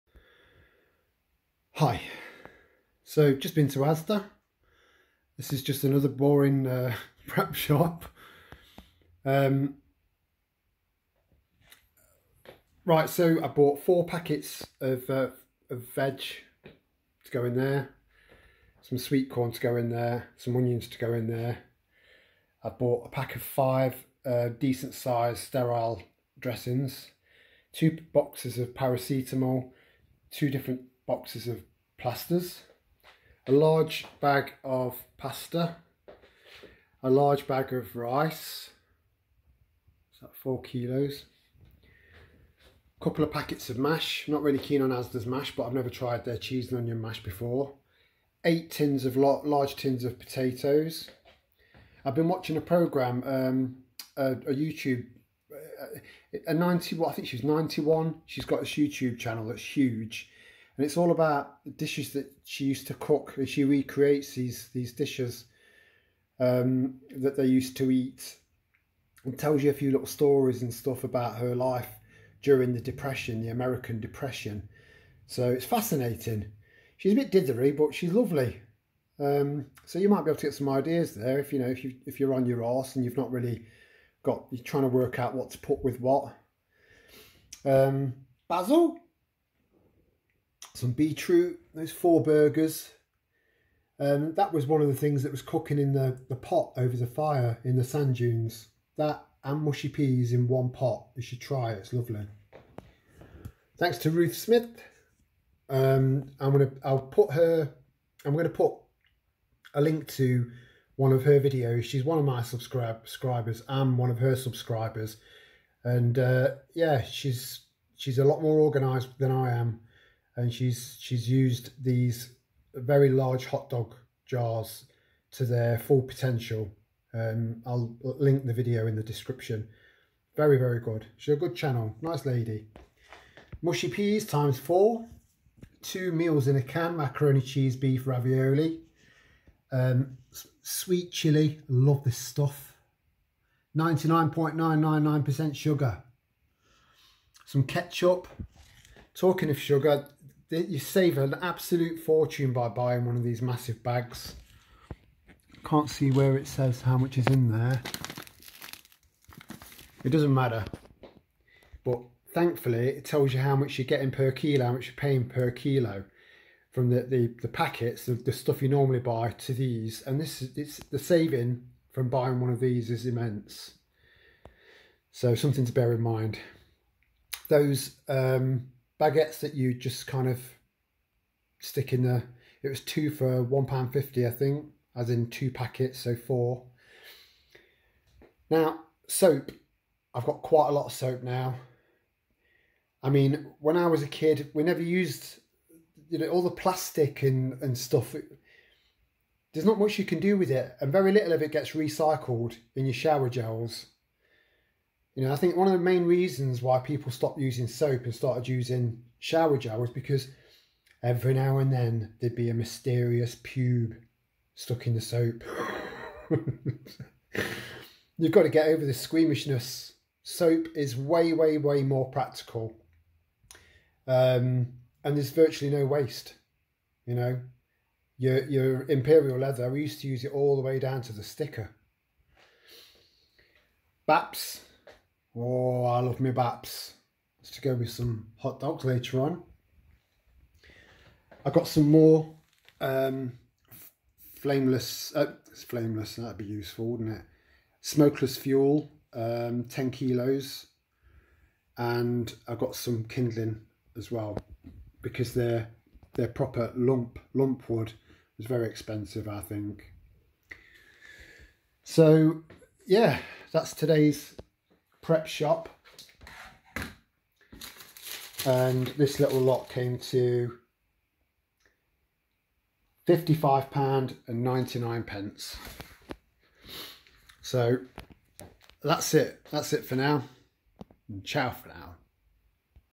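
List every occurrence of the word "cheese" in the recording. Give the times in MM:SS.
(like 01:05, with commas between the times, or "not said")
00:46, 02:17.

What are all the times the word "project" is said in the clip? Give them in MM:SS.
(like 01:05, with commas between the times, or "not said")
not said.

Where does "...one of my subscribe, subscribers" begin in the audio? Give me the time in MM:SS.
01:52.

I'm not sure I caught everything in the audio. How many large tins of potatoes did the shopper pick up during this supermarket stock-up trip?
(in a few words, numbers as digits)
8.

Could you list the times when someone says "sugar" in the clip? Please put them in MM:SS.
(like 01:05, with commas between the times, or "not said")
02:25, 02:29.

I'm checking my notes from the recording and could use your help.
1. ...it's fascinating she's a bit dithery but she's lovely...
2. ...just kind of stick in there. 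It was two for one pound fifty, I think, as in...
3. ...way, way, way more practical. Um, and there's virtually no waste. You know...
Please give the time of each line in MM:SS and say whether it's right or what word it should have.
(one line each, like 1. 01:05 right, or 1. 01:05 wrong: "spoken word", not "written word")
1. 01:15 right
2. 02:59 right
3. 03:40 right.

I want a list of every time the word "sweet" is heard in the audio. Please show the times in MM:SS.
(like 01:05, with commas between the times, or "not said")
00:18, 02:20.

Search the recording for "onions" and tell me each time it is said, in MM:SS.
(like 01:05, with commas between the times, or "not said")
00:20, 00:46.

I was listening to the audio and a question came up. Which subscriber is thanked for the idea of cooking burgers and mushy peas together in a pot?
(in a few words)
Ruth Smith.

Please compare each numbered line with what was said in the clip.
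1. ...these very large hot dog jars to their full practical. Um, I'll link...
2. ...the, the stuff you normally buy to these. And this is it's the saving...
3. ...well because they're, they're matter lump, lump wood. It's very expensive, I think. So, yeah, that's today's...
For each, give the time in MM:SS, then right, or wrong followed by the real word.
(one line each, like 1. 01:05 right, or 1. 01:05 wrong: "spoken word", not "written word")
1. 02:01 wrong: "potential", not "practical"
2. 02:48 right
3. 04:14 wrong: "proper", not "matter".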